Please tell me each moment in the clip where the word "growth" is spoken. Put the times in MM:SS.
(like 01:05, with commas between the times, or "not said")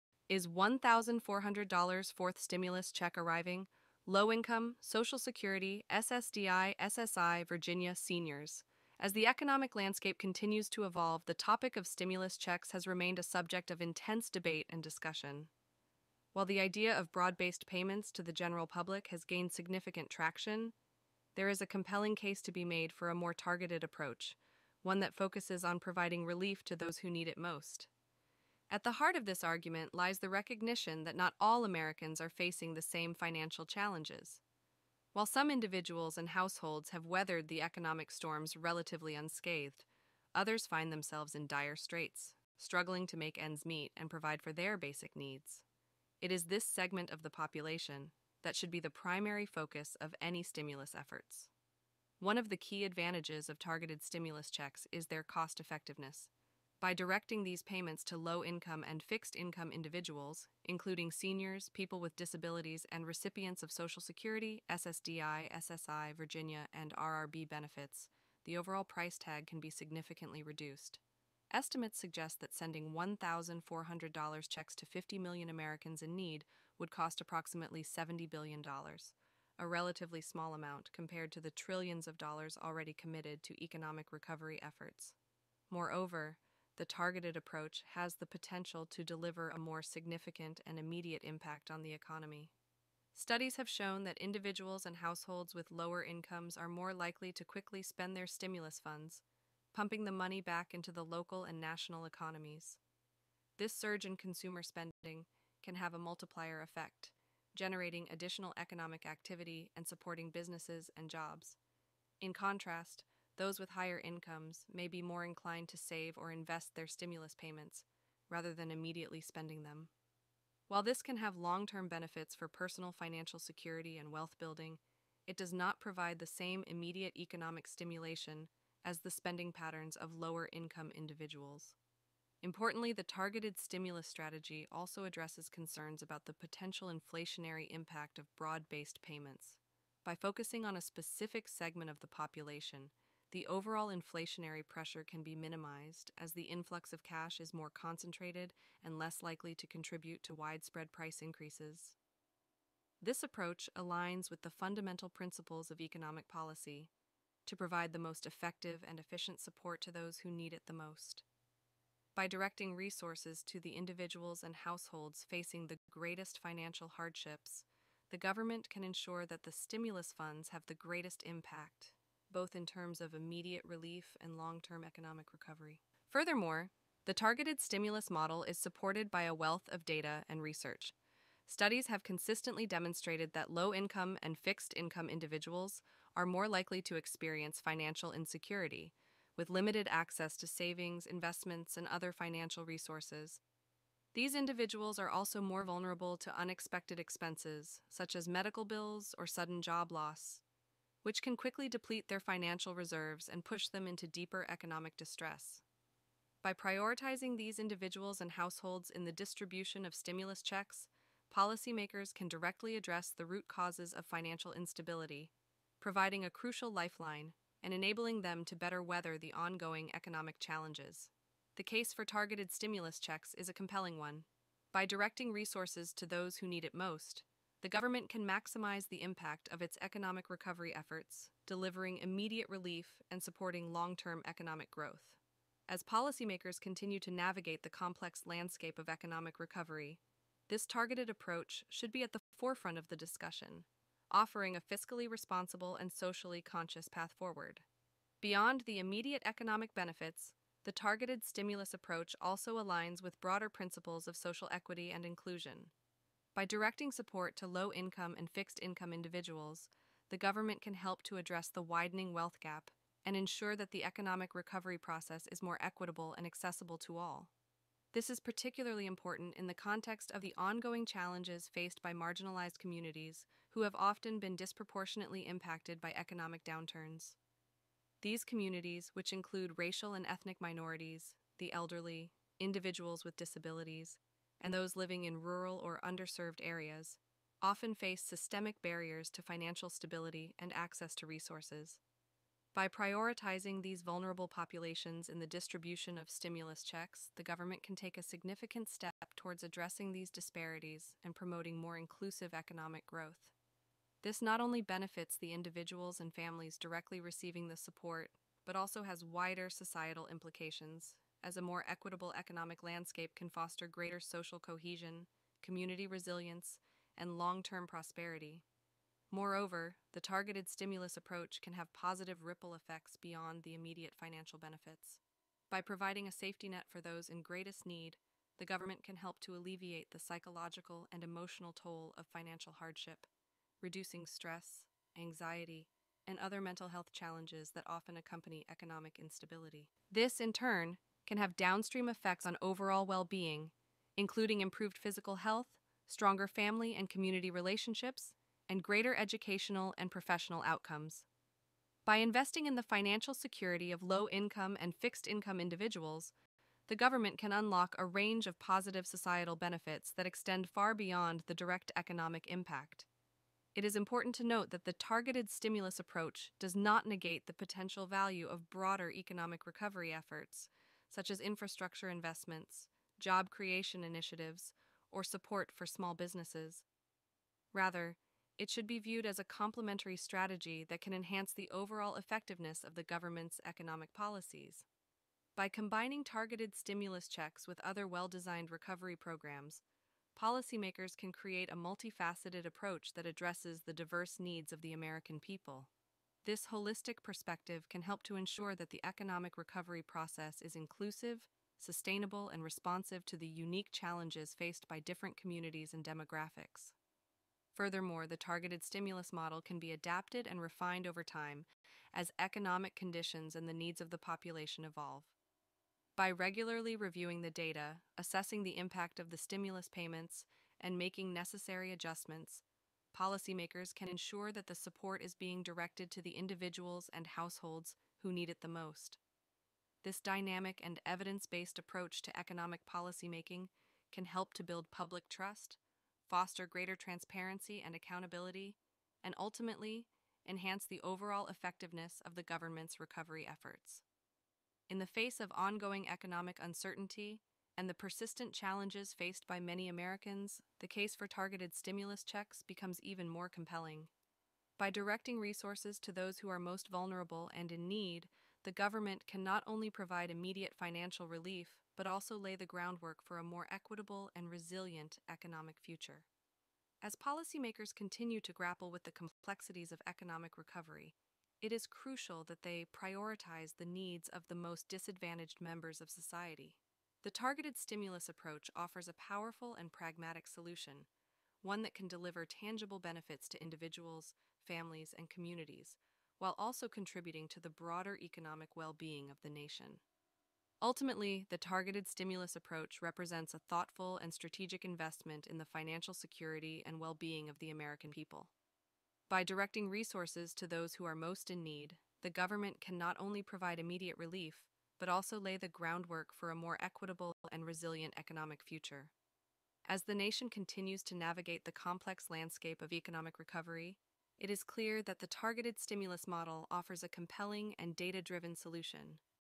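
03:54, 05:02.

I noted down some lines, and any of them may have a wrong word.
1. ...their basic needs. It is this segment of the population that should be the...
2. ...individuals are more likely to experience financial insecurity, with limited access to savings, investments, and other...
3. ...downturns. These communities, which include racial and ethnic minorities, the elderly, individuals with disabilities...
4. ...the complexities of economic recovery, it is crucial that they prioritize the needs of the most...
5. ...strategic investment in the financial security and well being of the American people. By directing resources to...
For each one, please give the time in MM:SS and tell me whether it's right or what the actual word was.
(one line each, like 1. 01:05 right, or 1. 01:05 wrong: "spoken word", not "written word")
1. 00:44 right
2. 03:05 right
3. 04:36 right
4. 07:48 right
5. 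08:14 right.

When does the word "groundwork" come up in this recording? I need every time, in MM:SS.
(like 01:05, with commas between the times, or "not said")
07:42, 08:25.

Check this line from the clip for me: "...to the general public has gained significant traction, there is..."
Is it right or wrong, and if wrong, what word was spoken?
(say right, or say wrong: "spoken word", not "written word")
right.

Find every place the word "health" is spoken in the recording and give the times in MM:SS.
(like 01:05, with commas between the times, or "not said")
05:36, 05:45.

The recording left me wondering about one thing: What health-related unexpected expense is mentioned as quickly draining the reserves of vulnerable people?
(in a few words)
medical bills.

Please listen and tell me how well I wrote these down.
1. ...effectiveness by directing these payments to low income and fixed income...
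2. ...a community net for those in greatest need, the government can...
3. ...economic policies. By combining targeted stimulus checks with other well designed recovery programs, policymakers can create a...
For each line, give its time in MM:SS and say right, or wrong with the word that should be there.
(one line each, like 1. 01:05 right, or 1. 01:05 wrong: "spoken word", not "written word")
1. 00:55 right
2. 05:26 wrong: "safety", not "community"
3. 06:23 right.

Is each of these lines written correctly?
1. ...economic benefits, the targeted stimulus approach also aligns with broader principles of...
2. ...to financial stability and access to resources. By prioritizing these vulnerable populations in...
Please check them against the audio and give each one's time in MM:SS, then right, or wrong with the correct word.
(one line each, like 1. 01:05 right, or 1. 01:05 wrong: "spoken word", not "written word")
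1. 04:09 right
2. 04:49 right.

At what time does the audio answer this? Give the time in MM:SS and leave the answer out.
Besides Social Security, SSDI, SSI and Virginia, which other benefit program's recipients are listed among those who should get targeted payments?
01:06.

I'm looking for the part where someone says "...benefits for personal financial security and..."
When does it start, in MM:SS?
02:01.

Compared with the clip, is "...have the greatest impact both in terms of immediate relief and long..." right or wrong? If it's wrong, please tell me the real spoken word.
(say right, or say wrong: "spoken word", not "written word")
right.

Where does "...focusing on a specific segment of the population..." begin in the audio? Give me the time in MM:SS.
02:20.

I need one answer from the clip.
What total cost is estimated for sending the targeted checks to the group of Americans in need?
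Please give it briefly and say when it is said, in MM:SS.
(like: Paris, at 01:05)
$70 billion, at 01:17.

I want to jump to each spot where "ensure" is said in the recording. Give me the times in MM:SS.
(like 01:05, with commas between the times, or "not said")
02:48, 04:23, 06:38, 07:03.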